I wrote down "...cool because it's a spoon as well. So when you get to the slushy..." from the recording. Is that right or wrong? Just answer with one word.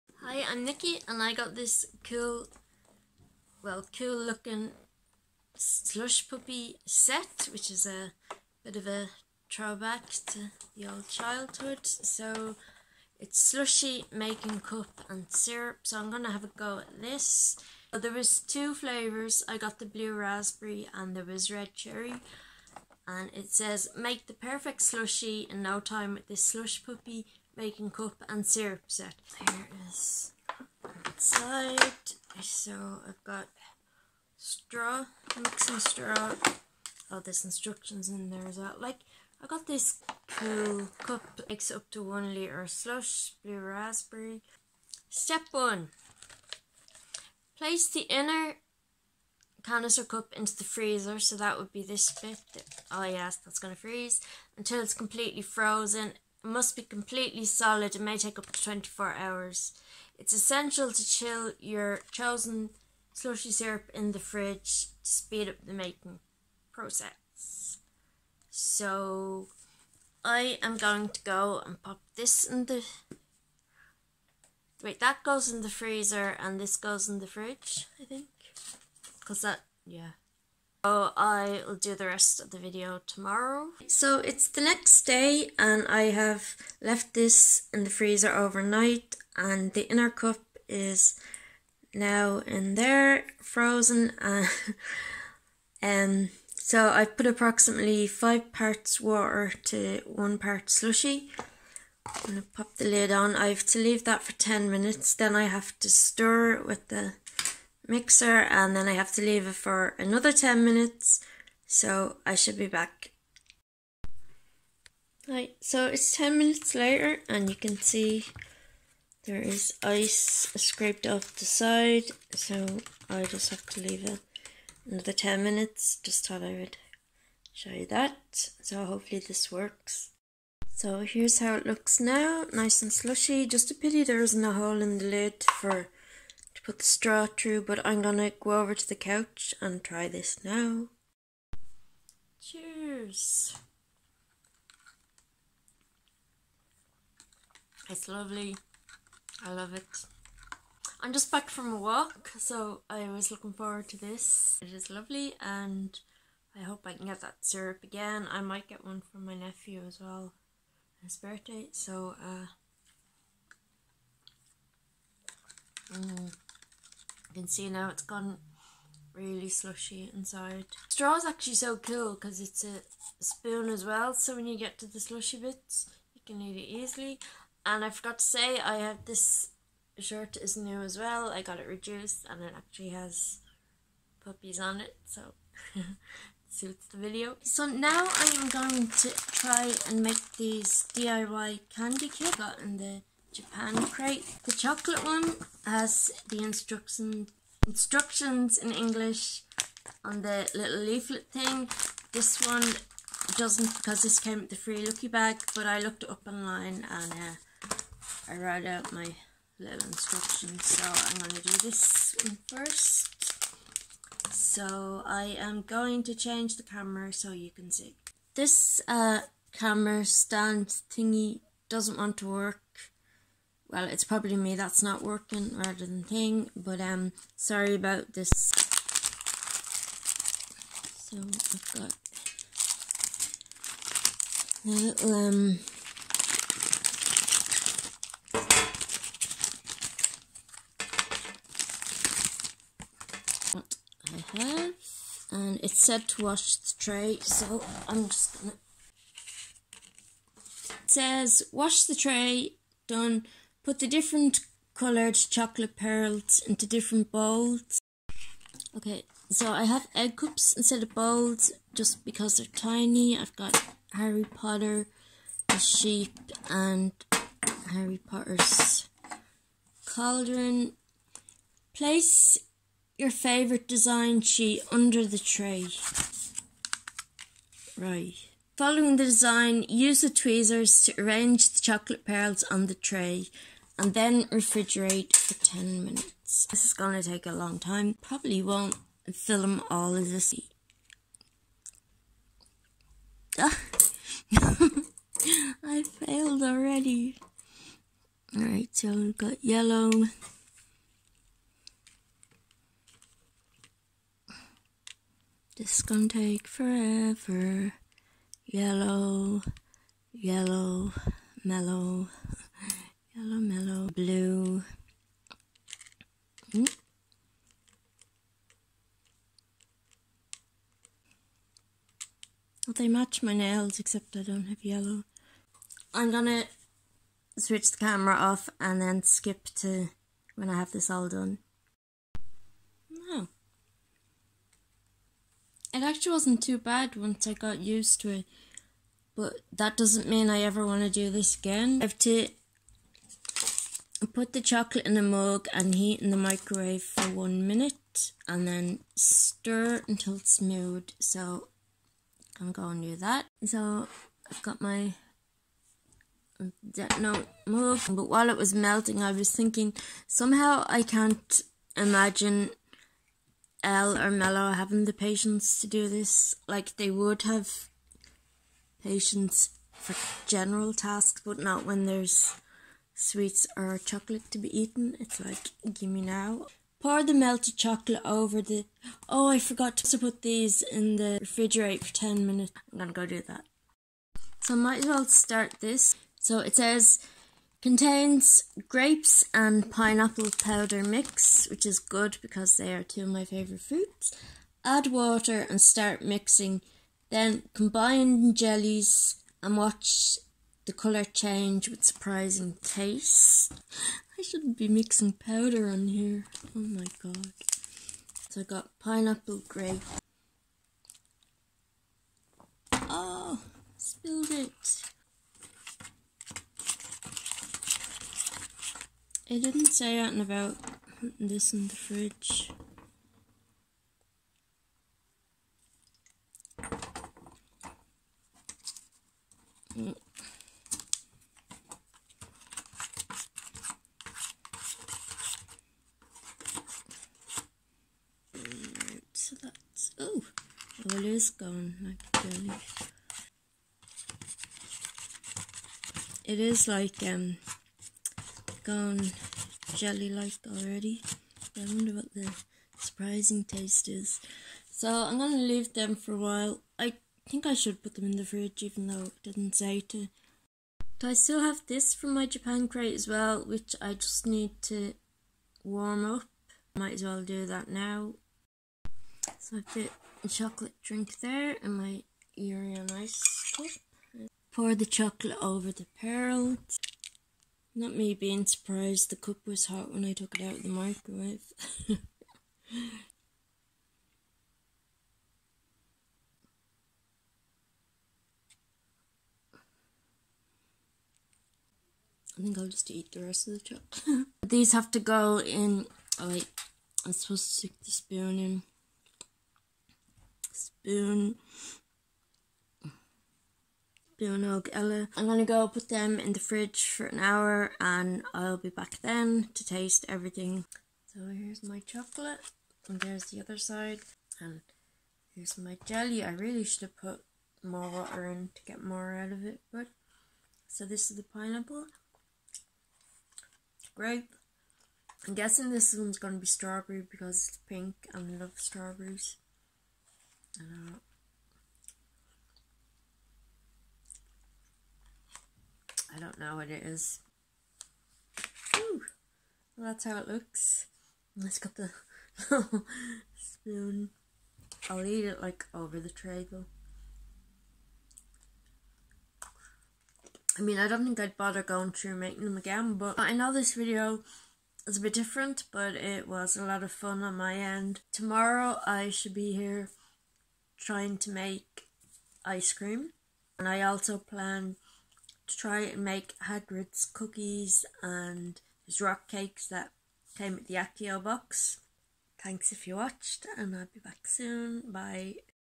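right.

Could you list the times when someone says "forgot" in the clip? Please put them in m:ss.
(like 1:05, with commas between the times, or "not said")
2:57, 6:19.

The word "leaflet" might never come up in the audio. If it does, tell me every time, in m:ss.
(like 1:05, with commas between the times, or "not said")
3:20.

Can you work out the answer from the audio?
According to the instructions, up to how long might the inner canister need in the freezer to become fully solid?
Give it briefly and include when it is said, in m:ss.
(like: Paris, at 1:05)
24 hours, at 0:58.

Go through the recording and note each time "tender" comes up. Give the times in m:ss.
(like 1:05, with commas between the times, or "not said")
not said.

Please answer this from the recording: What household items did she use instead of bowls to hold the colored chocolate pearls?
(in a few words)
egg cups.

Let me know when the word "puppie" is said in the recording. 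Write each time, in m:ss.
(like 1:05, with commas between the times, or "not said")
0:06, 0:26, 3:04.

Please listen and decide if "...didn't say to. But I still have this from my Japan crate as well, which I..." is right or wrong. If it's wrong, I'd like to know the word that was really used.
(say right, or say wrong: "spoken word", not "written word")
right.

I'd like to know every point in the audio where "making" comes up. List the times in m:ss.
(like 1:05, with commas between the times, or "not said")
0:14, 0:27, 1:05, 9:12.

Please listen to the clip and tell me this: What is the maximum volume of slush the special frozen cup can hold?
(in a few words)
1 liter.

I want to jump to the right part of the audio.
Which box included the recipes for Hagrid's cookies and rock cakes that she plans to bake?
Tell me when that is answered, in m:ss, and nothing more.
9:30.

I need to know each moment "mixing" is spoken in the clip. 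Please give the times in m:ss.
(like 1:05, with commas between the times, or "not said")
0:35, 6:36, 6:44.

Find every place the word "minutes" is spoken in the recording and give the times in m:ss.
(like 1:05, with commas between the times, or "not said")
1:44, 1:50, 1:56, 2:05, 4:45, 5:47, 6:22.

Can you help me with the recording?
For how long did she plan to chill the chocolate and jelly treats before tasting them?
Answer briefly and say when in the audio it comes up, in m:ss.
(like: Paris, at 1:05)
an hour, at 8:27.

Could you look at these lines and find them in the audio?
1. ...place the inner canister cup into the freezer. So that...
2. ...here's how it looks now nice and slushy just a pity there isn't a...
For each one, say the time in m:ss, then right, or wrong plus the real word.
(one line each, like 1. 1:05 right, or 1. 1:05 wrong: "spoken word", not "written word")
1. 0:47 right
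2. 2:11 right.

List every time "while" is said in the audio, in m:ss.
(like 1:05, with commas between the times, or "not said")
5:58, 7:36.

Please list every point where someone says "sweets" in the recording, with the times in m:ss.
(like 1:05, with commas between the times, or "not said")
6:12.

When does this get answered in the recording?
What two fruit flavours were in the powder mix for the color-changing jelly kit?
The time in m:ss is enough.
6:28.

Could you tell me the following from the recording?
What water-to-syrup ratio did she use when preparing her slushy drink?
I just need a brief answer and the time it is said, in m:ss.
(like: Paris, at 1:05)
5 parts water to 1 part, at 1:38.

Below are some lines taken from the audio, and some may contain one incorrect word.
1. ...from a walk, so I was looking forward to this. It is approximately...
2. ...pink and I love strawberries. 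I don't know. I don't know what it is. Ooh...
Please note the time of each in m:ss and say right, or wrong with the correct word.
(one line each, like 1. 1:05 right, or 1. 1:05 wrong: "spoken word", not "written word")
1. 2:31 wrong: "lovely", not "approximately"
2. 8:47 right.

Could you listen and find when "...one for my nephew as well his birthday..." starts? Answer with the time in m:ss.
2:38.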